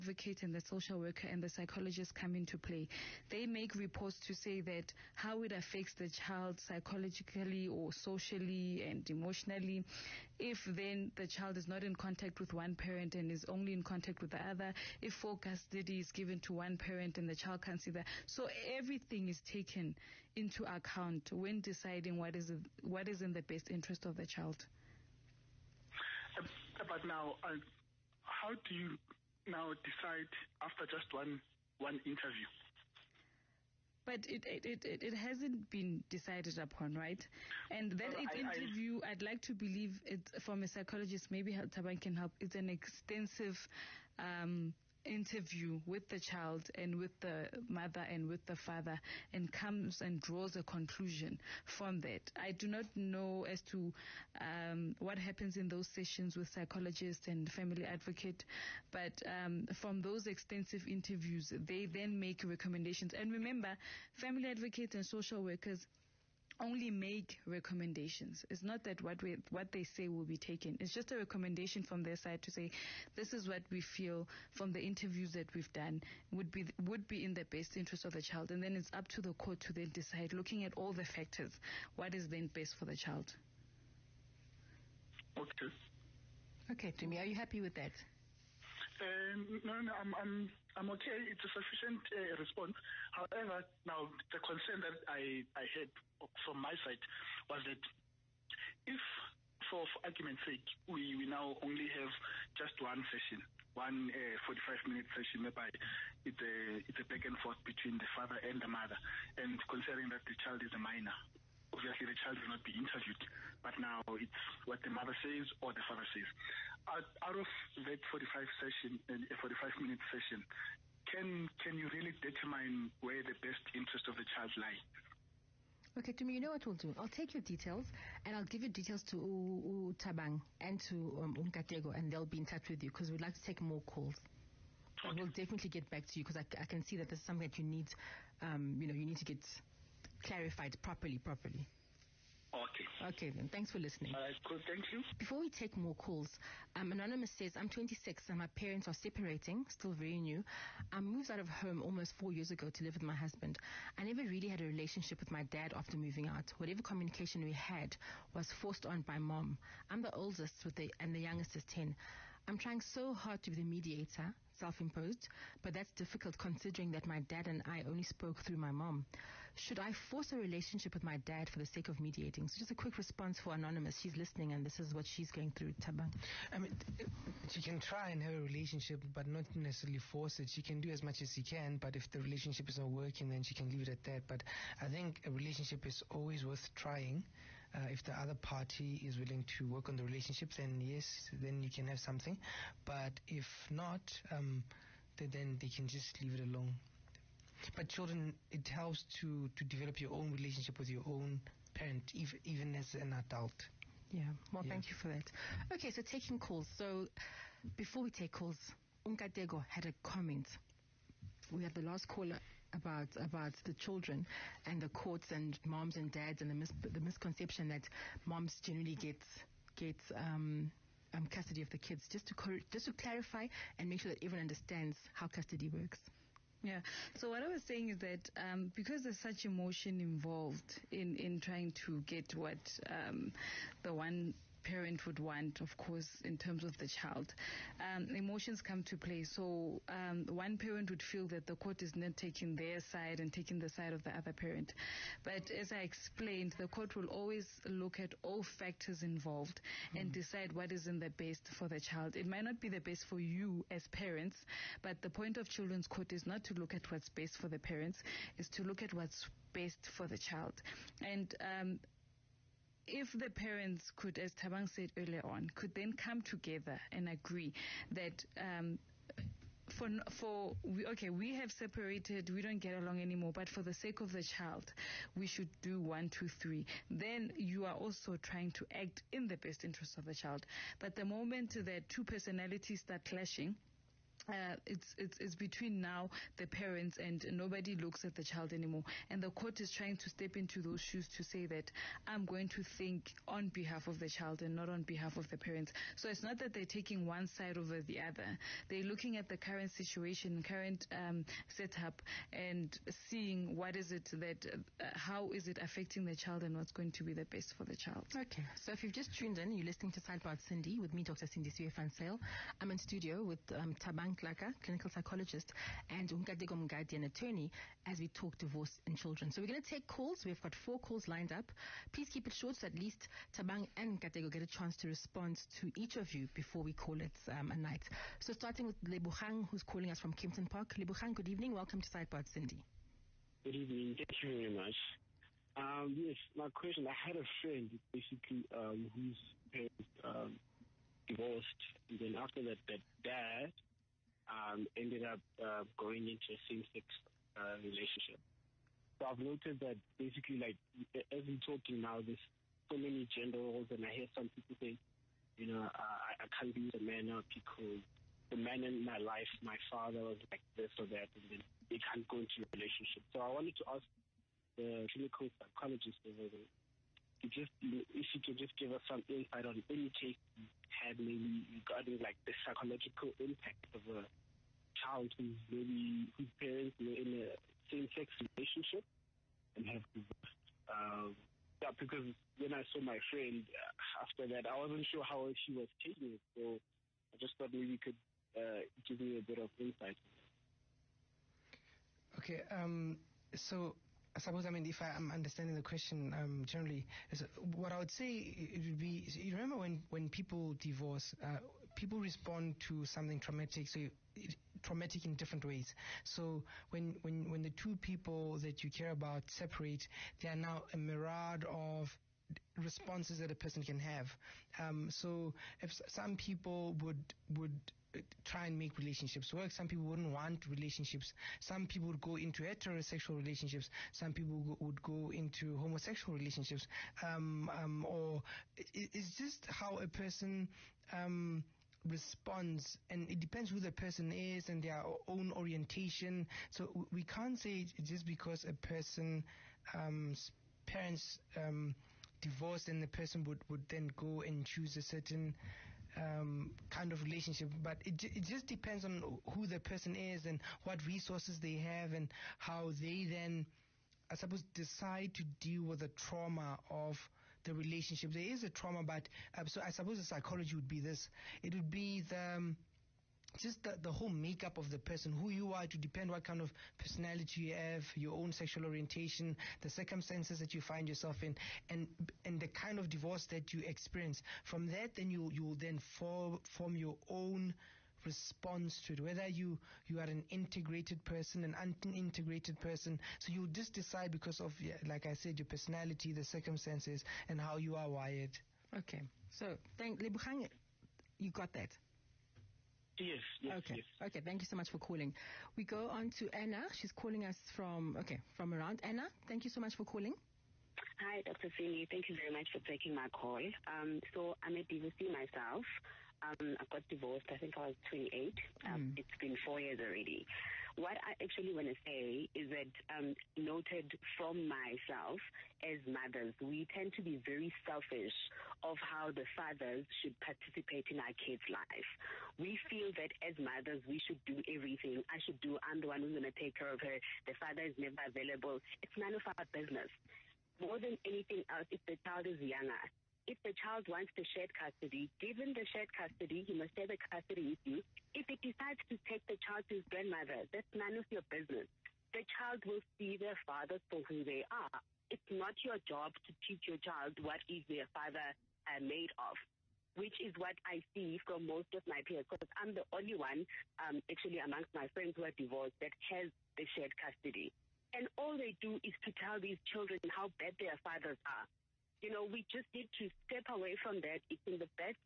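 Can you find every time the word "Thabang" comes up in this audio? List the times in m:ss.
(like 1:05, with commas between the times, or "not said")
0:41, 2:09, 2:55, 4:24, 5:13, 5:23.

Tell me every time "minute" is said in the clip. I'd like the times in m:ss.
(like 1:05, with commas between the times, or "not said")
1:44, 1:59.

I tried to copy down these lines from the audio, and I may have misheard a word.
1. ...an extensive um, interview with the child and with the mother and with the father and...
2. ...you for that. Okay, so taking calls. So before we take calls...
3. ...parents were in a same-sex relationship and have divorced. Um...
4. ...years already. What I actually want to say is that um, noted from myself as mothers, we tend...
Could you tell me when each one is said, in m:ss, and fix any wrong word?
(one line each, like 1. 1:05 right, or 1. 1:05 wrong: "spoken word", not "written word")
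1. 0:42 right
2. 3:24 right
3. 6:16 right
4. 8:29 right.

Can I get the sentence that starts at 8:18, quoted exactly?
Anna, thank you so much for calling.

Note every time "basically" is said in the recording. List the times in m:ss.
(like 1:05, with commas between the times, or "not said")
5:37, 5:49.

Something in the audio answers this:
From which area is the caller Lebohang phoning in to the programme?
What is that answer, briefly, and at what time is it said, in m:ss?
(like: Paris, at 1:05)
Kempton Park, at 5:30.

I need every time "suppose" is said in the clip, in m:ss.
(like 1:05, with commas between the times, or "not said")
6:34, 7:34, 7:39.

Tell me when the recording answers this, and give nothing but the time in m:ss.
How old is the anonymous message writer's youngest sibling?
2:41.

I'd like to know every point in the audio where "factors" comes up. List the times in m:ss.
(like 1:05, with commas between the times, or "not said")
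1:21, 4:08.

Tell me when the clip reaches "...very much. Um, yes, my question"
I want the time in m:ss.
5:34.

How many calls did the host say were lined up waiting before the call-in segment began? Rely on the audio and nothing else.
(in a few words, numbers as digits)
4.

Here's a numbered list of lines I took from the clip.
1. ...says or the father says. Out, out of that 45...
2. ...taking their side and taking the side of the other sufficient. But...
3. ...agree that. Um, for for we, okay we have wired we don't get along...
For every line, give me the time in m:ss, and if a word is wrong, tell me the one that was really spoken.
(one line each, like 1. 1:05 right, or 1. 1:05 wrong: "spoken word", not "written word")
1. 1:55 right
2. 4:02 wrong: "parent", not "sufficient"
3. 4:27 wrong: "separated", not "wired".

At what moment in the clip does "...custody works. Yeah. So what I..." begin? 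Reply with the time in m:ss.
3:45.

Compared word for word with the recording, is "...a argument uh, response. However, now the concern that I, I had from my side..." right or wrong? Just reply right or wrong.
wrong.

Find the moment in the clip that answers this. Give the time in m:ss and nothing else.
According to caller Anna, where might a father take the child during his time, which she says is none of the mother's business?
8:59.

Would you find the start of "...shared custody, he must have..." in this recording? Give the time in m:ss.
8:55.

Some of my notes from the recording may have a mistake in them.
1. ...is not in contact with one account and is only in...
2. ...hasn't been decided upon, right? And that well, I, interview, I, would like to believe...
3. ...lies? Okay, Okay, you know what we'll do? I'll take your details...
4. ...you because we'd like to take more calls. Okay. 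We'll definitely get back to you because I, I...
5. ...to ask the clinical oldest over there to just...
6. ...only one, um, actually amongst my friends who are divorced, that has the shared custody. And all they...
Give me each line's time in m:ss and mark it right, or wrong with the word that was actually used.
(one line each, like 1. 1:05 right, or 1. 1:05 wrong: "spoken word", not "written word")
1. 0:11 wrong: "parent", not "account"
2. 0:35 right
3. 2:04 wrong: "Tumi", not "Okay"
4. 2:12 right
5. 6:03 wrong: "psychologist", not "oldest"
6. 9:12 right.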